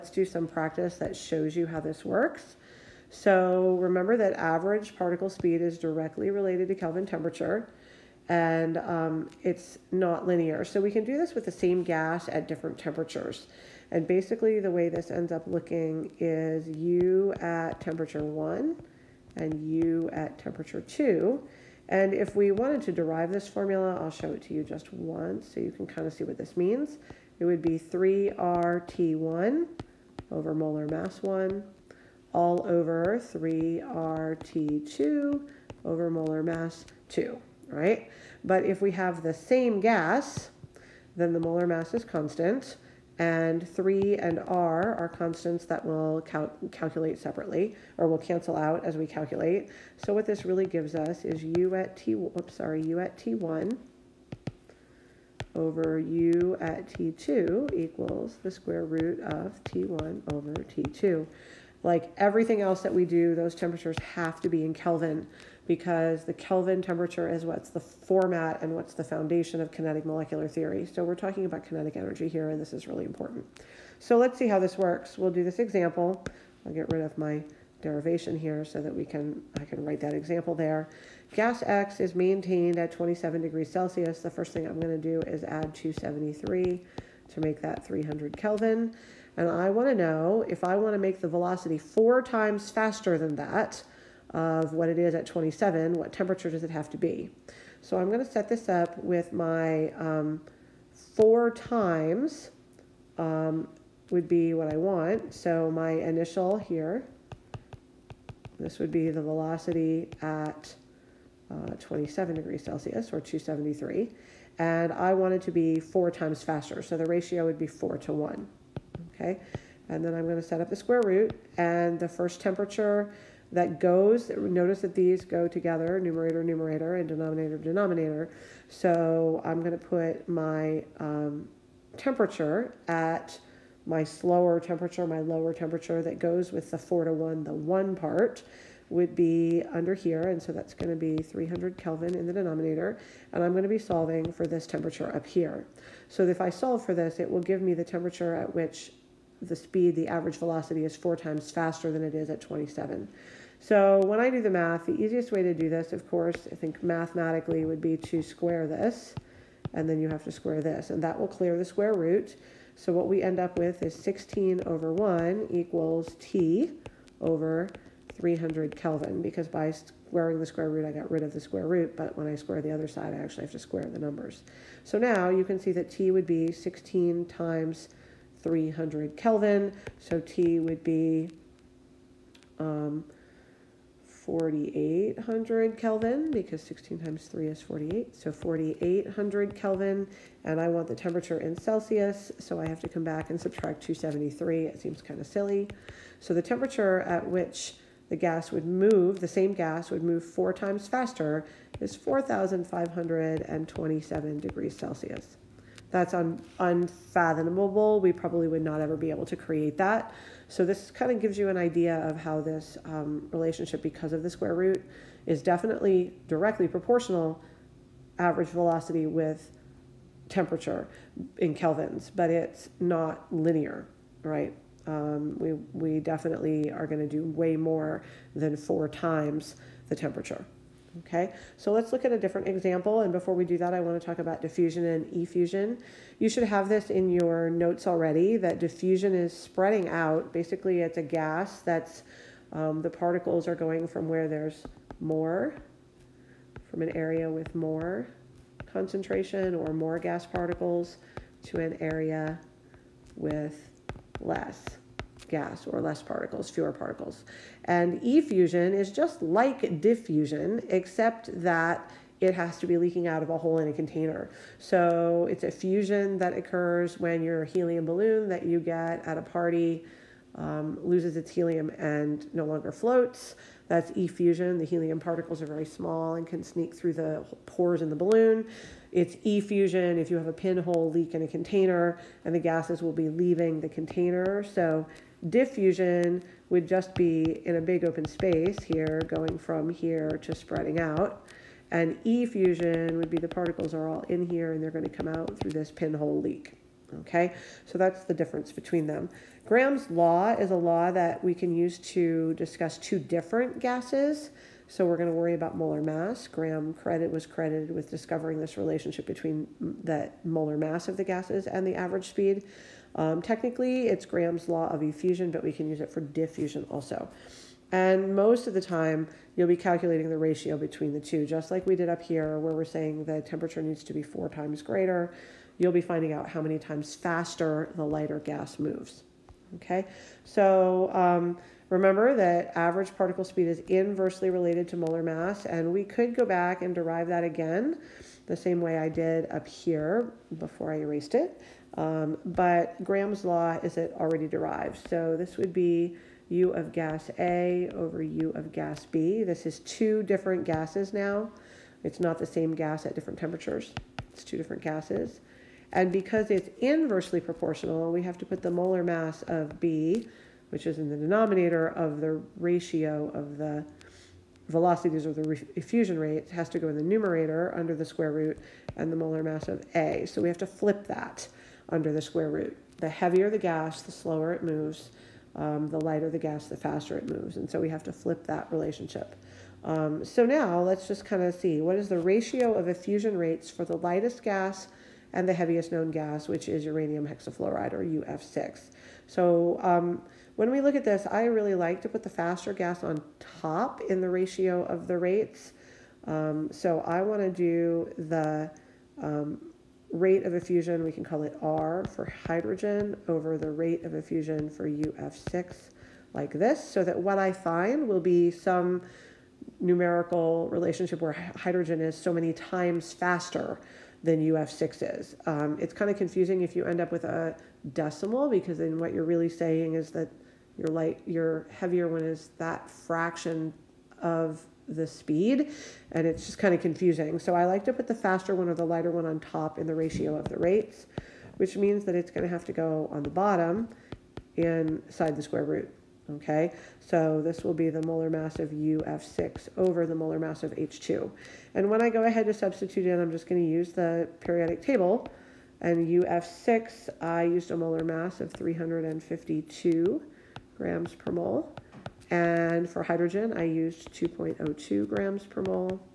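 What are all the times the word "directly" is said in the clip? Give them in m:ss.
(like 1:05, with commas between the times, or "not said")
0:05, 3:36.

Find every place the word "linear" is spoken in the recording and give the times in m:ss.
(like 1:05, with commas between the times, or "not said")
0:10, 3:43.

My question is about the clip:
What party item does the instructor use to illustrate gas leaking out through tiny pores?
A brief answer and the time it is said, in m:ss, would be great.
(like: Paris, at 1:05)
helium balloon, at 4:27.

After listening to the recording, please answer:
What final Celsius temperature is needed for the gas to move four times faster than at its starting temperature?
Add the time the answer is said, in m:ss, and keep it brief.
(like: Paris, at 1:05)
4527 degrees Celsius, at 3:21.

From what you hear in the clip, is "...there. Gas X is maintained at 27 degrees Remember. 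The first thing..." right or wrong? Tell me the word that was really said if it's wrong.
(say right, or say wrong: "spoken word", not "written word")
wrong: "Celsius", not "Remember".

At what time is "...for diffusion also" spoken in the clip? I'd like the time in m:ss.
5:15.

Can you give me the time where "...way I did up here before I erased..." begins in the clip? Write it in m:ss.
5:38.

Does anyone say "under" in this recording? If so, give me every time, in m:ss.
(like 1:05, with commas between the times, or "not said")
2:19, 6:07, 6:11.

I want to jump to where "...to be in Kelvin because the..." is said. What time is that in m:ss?
1:04.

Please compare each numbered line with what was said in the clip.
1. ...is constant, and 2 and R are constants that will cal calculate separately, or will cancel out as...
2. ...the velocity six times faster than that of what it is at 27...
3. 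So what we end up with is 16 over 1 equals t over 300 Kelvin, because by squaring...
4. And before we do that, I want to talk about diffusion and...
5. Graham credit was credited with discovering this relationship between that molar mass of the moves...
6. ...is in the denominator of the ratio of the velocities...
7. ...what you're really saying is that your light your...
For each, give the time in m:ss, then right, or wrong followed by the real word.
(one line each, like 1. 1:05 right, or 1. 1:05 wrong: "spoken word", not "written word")
1. 0:41 wrong: "3", not "2"
2. 1:31 wrong: "four", not "six"
3. 2:42 right
4. 3:52 right
5. 5:06 wrong: "gases", not "moves"
6. 6:00 right
7. 6:58 right.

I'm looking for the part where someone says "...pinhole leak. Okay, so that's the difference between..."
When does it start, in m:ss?
4:55.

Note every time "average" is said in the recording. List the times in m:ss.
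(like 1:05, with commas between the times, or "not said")
0:04, 2:30, 3:38, 5:11, 5:32.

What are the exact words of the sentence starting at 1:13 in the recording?
So let's see how this works.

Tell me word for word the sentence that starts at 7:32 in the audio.
And for hydrogen, I used 2.02 grams per mole.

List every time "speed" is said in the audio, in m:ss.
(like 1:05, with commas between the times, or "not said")
0:05, 2:29, 5:12, 5:33, 7:04.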